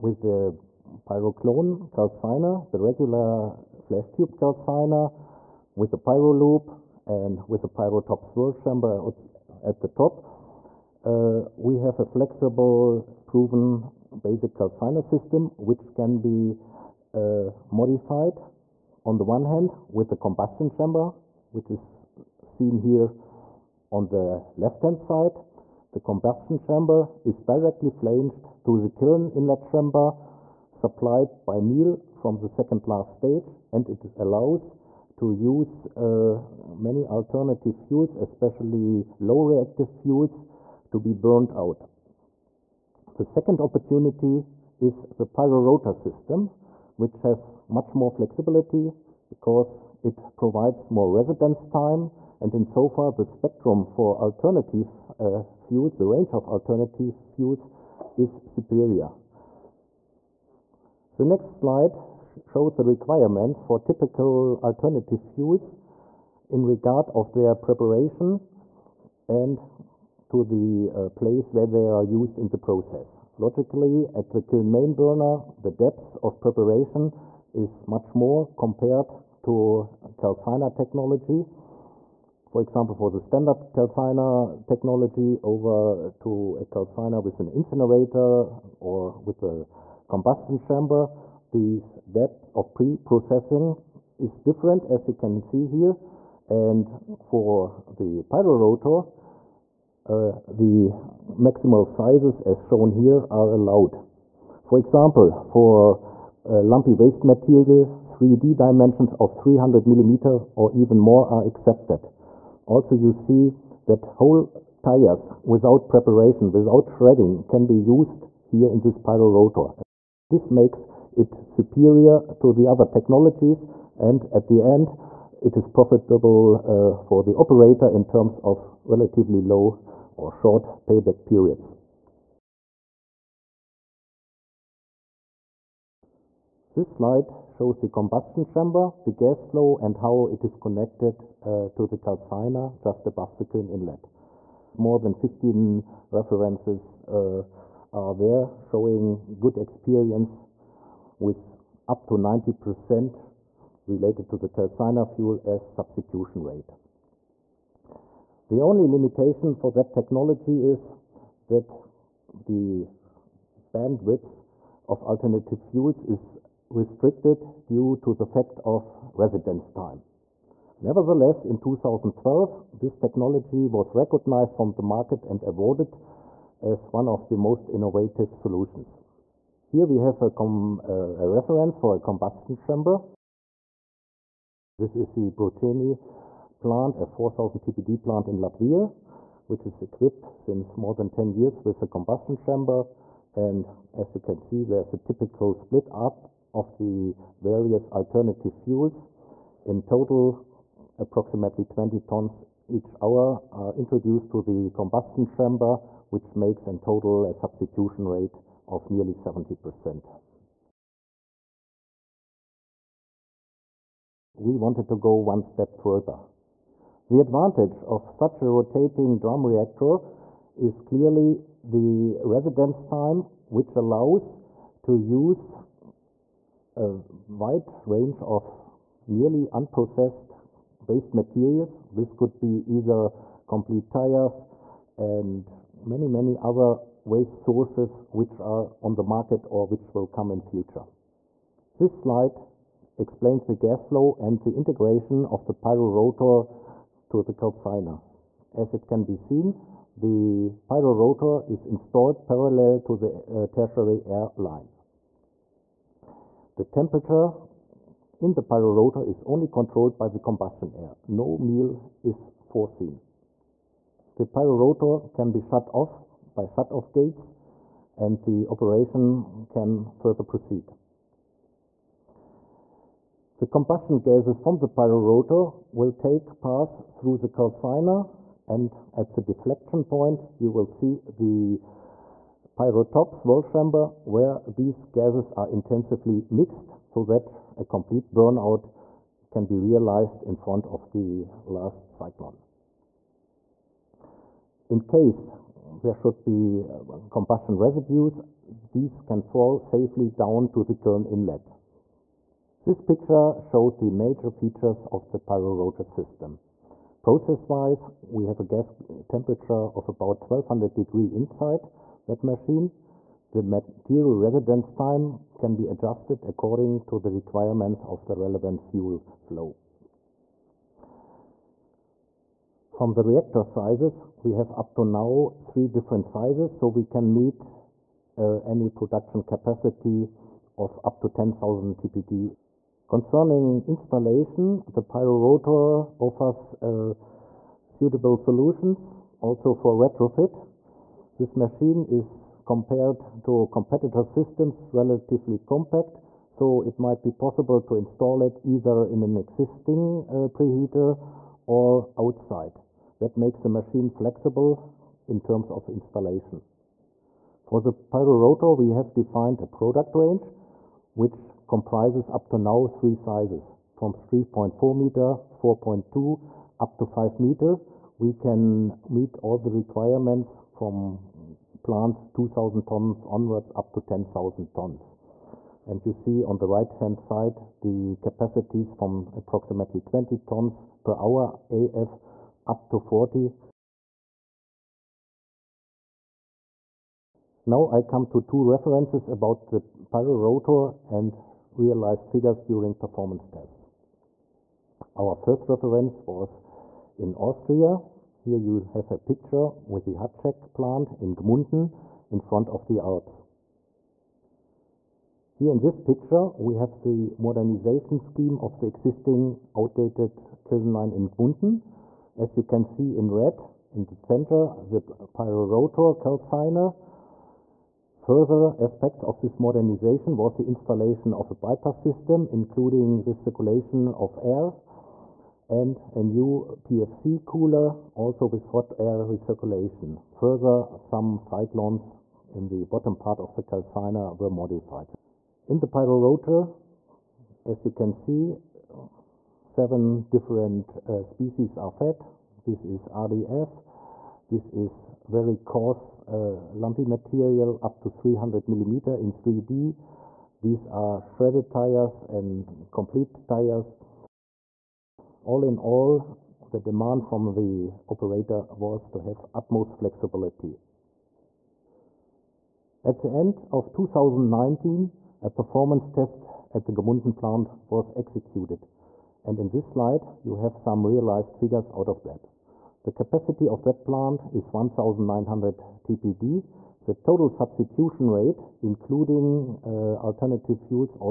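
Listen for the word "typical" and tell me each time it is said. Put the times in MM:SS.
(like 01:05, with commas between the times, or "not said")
01:03, 03:14.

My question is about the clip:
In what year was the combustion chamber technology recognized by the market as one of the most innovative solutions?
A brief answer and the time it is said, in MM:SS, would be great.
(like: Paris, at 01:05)
2012, at 02:51.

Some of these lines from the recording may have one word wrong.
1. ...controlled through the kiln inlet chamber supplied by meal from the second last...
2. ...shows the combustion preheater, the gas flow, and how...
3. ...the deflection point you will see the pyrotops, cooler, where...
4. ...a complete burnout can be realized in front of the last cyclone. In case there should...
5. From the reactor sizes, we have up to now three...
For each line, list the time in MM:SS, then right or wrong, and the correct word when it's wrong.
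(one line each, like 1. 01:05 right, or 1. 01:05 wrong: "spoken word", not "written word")
1. 00:27 wrong: "flanged", not "controlled"
2. 02:17 wrong: "chamber", not "preheater"
3. 04:39 wrong: "chamber", not "cooler"
4. 04:47 right
5. 05:22 right.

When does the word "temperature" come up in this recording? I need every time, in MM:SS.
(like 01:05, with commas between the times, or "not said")
04:16, 05:09.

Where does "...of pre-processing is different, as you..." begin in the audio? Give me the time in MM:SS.
01:32.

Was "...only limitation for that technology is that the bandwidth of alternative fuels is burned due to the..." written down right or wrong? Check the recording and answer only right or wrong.
wrong.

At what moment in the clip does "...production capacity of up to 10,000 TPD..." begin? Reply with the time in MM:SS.
05:28.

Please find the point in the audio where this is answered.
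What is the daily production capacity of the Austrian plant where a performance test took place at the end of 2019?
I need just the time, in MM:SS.
07:54.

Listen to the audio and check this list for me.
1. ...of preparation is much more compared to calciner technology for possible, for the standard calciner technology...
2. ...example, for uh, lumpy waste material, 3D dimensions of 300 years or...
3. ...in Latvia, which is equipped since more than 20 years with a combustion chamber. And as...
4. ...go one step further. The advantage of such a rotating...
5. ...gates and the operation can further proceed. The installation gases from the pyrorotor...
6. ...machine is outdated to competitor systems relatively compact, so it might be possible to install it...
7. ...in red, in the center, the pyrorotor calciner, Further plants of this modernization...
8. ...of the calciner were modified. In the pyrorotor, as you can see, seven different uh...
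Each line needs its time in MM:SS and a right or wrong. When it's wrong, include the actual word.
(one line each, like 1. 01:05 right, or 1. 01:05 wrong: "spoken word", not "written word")
1. 01:16 wrong: "example", not "possible"
2. 01:44 wrong: "millimeters", not "years"
3. 03:08 wrong: "10", not "20"
4. 03:34 right
5. 04:26 wrong: "combustion", not "installation"
6. 05:41 wrong: "compared", not "outdated"
7. 06:52 wrong: "aspects", not "plants"
8. 07:13 right.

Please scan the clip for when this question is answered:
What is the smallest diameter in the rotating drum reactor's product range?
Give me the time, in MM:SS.
06:03.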